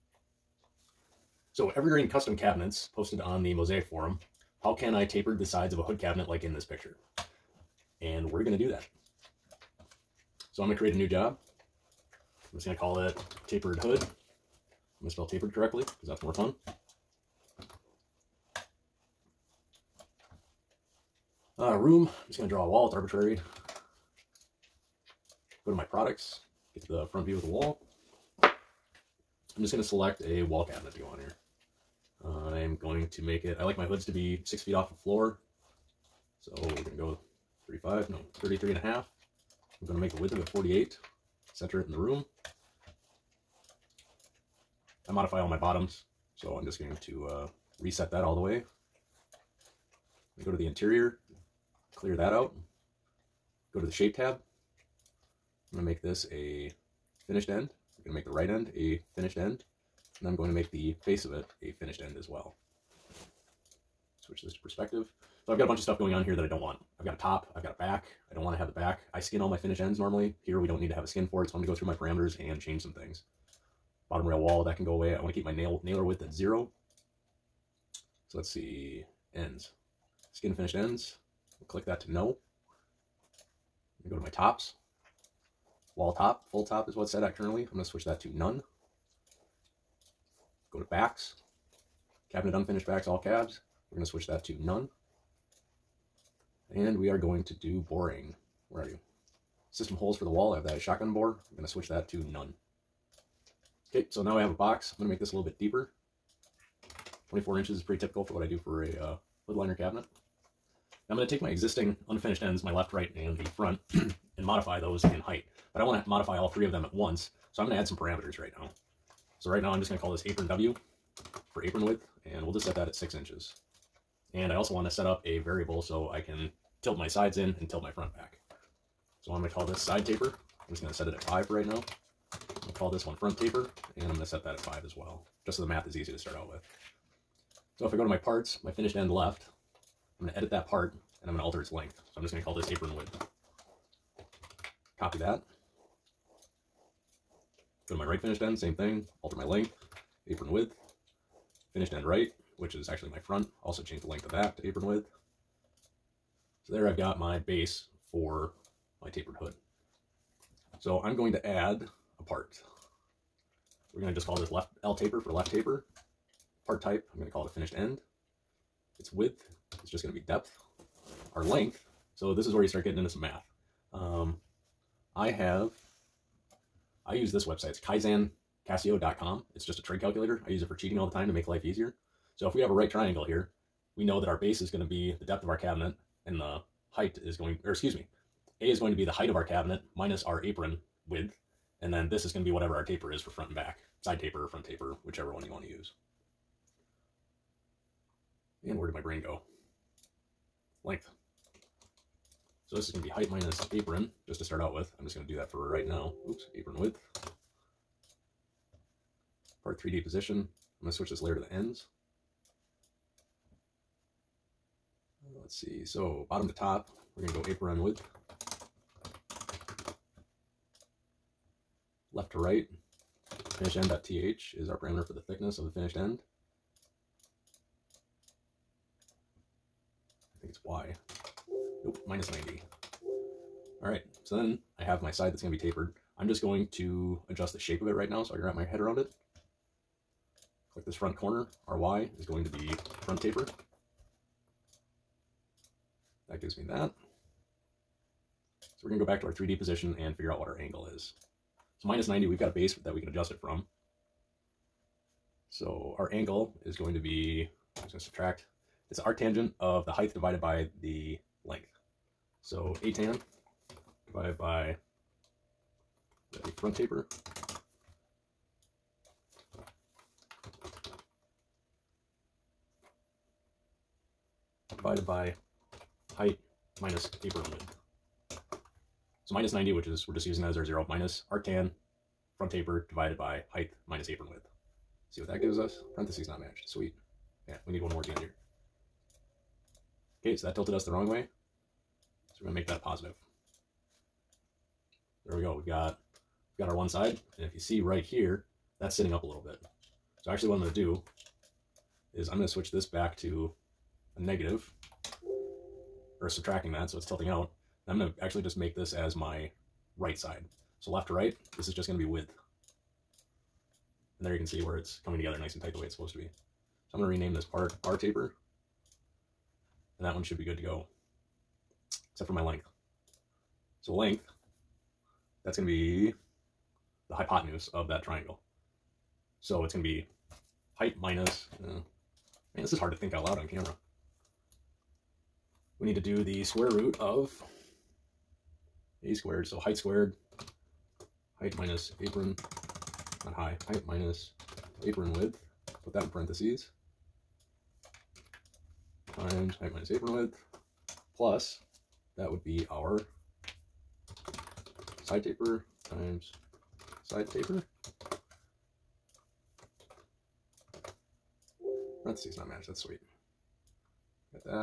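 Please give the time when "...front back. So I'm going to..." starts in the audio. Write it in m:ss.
2:07.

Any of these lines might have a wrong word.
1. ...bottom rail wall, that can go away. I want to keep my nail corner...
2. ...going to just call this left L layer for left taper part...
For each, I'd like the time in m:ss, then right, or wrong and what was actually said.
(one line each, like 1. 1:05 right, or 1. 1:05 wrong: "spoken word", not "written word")
1. 1:14 wrong: "nailer", not "corner"
2. 2:43 wrong: "taper", not "layer".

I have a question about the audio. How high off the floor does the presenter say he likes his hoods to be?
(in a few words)
6 feet.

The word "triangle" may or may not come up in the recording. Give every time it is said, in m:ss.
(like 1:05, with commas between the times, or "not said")
3:02, 5:28.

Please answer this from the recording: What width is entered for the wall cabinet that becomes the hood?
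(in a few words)
48.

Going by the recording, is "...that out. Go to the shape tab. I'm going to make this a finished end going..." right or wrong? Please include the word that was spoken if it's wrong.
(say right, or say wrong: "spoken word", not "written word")
right.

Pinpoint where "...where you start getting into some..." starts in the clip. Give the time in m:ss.
2:52.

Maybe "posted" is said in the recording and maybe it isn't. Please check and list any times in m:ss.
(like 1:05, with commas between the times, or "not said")
0:02.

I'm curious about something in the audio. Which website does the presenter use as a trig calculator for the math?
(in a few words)
keisan.casio.com.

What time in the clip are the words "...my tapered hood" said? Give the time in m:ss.
2:39.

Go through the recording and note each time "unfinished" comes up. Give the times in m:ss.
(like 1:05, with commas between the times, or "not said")
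1:32, 1:52.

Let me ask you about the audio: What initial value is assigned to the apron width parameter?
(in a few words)
6 inches.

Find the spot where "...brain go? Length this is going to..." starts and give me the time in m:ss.
3:18.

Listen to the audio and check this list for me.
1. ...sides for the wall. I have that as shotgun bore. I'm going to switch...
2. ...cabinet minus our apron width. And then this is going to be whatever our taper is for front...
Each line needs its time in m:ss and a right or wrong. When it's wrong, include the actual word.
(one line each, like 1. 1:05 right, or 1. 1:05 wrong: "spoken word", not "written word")
1. 1:39 wrong: "holes", not "sides"
2. 3:09 right.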